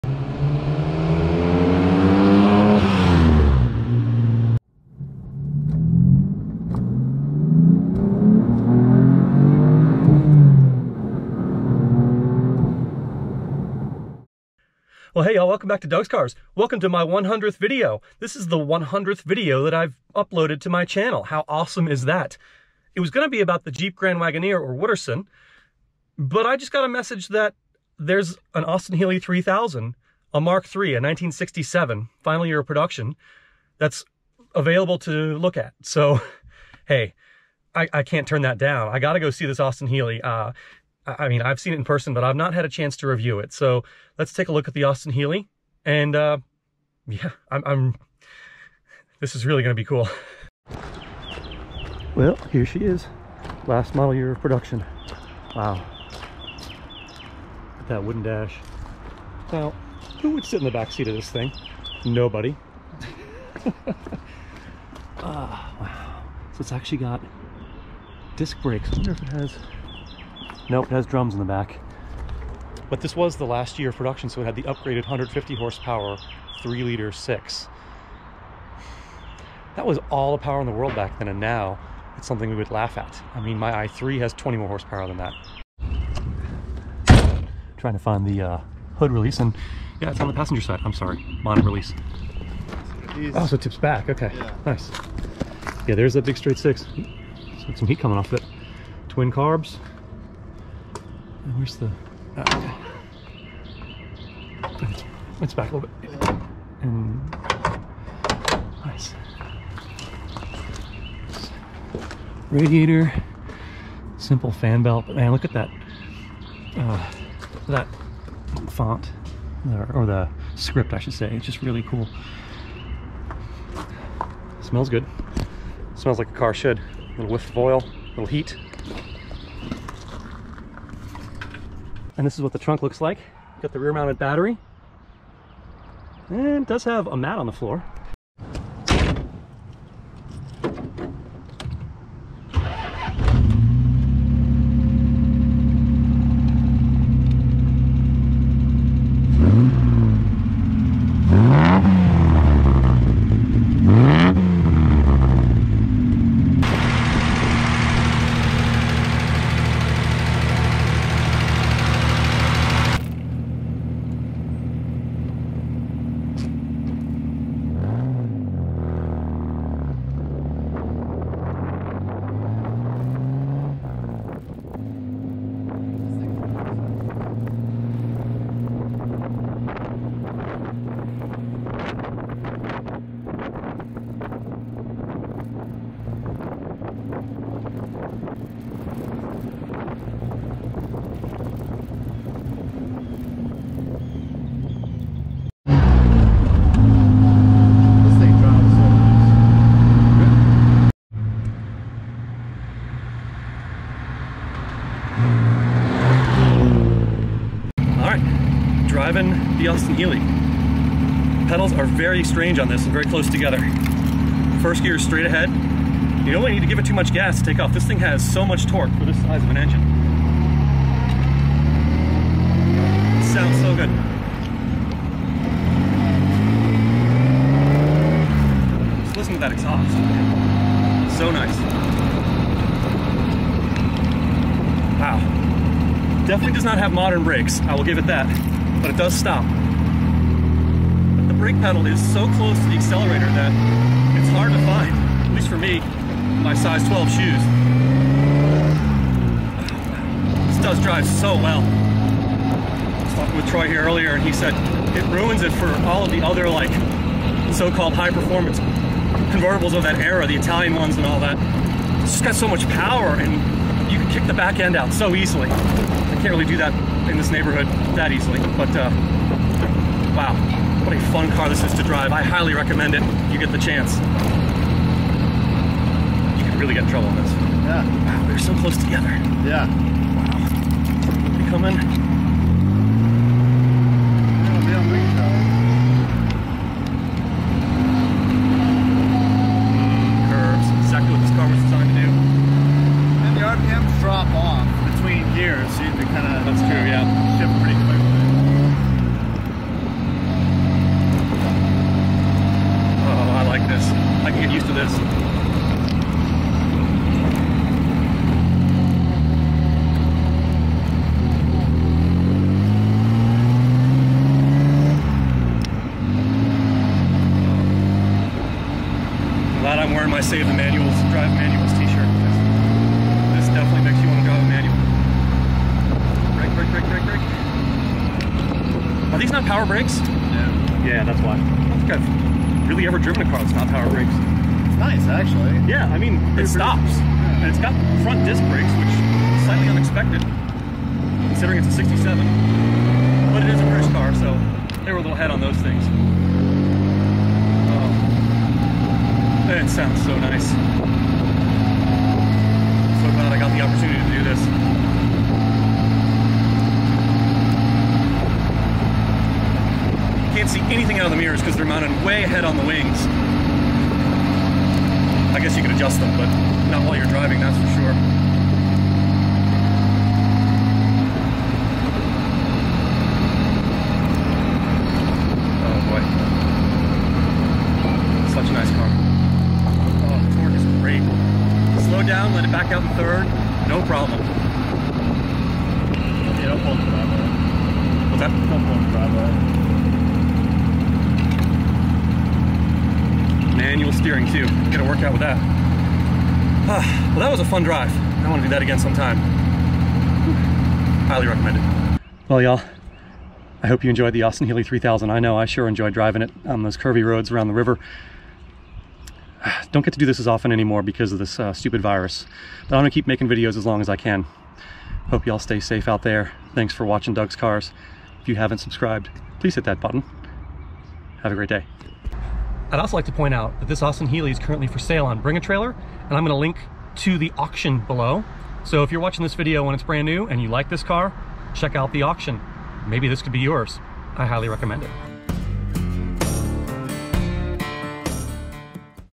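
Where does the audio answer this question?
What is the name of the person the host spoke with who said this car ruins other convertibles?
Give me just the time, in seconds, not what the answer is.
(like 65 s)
253 s.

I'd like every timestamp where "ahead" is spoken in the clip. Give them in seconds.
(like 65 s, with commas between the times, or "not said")
215 s, 362 s.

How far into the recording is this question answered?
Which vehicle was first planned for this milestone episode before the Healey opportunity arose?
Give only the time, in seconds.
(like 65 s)
23 s.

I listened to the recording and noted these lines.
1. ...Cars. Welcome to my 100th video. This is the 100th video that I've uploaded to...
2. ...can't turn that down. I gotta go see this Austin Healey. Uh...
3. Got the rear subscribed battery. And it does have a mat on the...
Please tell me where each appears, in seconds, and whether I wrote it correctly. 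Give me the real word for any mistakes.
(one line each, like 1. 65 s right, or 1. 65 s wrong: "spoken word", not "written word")
1. 16 s right
2. 38 s right
3. 133 s wrong: "mounted", not "subscribed".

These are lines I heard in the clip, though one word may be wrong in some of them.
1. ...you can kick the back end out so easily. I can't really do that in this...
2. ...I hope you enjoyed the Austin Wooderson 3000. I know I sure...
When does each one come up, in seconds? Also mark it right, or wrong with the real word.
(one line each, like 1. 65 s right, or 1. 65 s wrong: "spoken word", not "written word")
1. 263 s right
2. 403 s wrong: "Healey", not "Wooderson".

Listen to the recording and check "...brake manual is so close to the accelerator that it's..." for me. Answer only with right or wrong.
wrong.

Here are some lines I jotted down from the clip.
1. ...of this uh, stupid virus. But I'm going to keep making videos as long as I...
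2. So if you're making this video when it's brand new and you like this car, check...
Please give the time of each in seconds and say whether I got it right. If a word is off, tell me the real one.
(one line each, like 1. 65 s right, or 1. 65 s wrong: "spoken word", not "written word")
1. 411 s right
2. 428 s wrong: "watching", not "making".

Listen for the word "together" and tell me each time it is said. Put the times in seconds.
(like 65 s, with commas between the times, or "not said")
213 s, 278 s.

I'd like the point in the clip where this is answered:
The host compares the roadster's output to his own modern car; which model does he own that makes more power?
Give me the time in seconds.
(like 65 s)
83 s.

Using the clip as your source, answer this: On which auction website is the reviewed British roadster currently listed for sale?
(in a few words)
Bring a Trailer.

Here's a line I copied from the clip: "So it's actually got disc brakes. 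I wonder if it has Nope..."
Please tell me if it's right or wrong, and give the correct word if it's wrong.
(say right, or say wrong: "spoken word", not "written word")
right.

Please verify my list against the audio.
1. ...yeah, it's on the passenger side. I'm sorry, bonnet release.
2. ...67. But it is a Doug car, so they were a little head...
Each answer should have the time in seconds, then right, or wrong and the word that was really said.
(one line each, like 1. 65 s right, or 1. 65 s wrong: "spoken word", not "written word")
1. 90 s right
2. 341 s wrong: "British", not "Doug".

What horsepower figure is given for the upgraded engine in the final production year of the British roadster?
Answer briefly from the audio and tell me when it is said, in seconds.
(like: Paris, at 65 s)
150, at 75 s.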